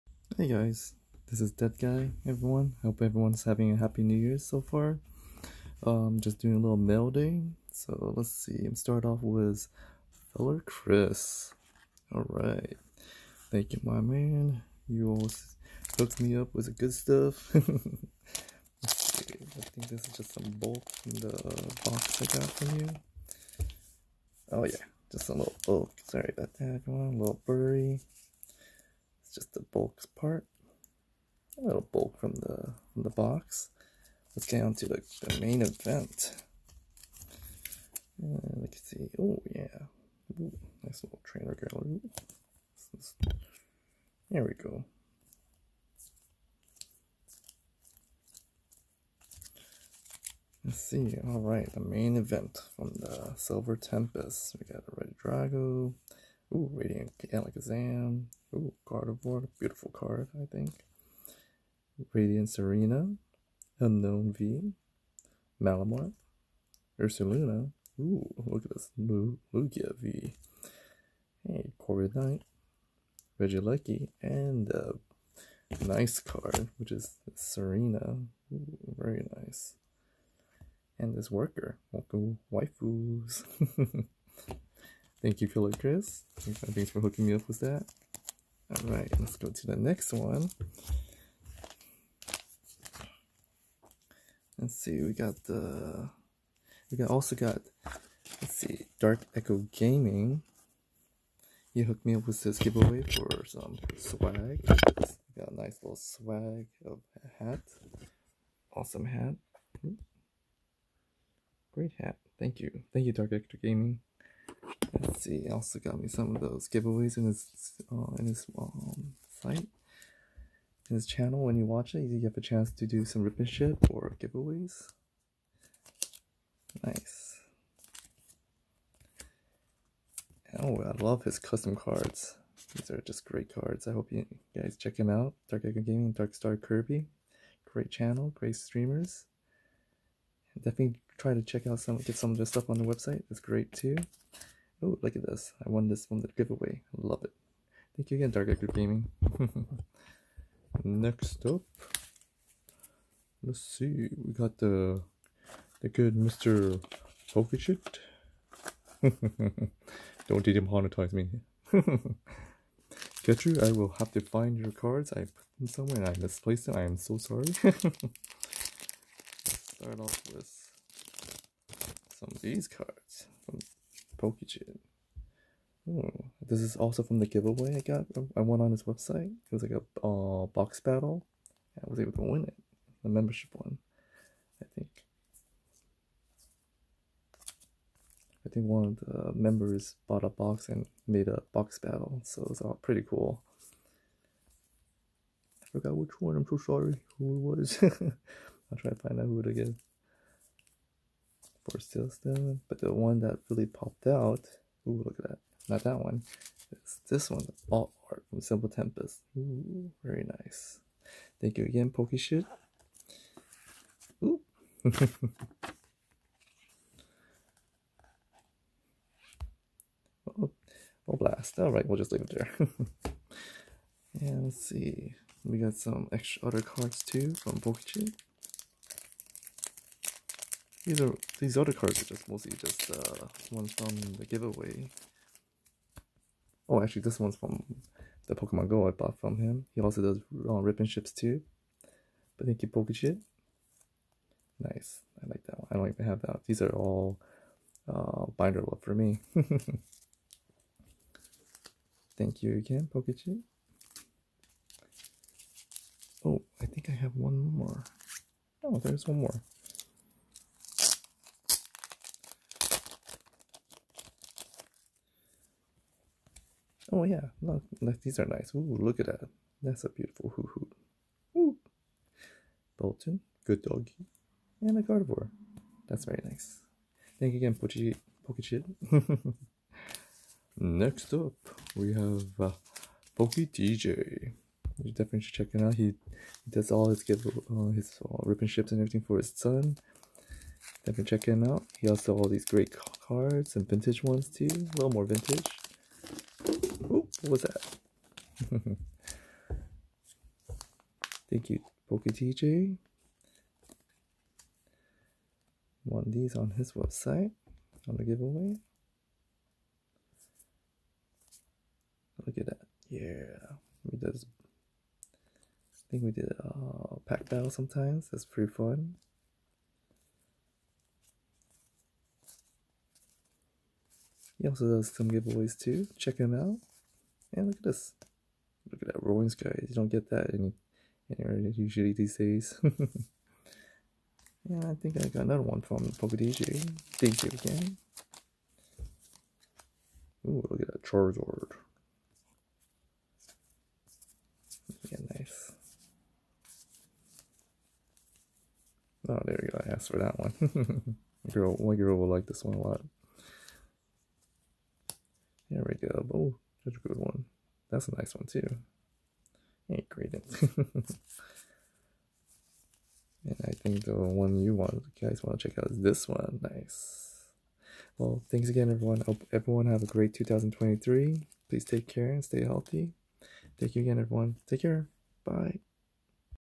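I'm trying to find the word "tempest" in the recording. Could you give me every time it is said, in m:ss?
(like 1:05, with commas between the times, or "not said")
0:53, 3:28.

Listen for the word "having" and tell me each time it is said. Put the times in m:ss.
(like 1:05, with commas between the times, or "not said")
0:03.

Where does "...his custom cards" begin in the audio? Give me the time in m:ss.
2:11.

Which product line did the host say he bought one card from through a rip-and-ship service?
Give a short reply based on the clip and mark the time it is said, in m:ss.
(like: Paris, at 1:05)
Pokemon Go, at 3:58.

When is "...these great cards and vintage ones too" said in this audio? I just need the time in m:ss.
4:52.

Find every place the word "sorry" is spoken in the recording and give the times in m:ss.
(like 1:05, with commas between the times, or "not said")
0:26, 2:47, 3:16.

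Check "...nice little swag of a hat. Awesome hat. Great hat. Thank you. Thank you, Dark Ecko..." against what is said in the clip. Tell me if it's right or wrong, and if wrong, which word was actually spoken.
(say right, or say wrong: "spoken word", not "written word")
right.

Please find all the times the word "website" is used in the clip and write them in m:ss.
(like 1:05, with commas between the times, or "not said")
2:22, 2:58, 5:06.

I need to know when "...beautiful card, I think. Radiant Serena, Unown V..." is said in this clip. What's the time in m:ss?
0:59.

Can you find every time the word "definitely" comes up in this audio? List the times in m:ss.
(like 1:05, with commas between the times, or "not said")
2:20, 4:44, 4:50.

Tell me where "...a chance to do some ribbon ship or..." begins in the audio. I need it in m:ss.
2:02.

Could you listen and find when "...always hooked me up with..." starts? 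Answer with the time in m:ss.
0:15.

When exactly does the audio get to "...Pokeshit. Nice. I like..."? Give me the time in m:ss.
4:02.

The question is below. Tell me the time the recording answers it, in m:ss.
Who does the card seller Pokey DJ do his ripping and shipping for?
4:49.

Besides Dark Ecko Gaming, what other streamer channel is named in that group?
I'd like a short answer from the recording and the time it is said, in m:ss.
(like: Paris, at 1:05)
Dark Star Kirby, at 2:16.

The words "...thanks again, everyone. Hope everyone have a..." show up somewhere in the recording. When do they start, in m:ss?
6:08.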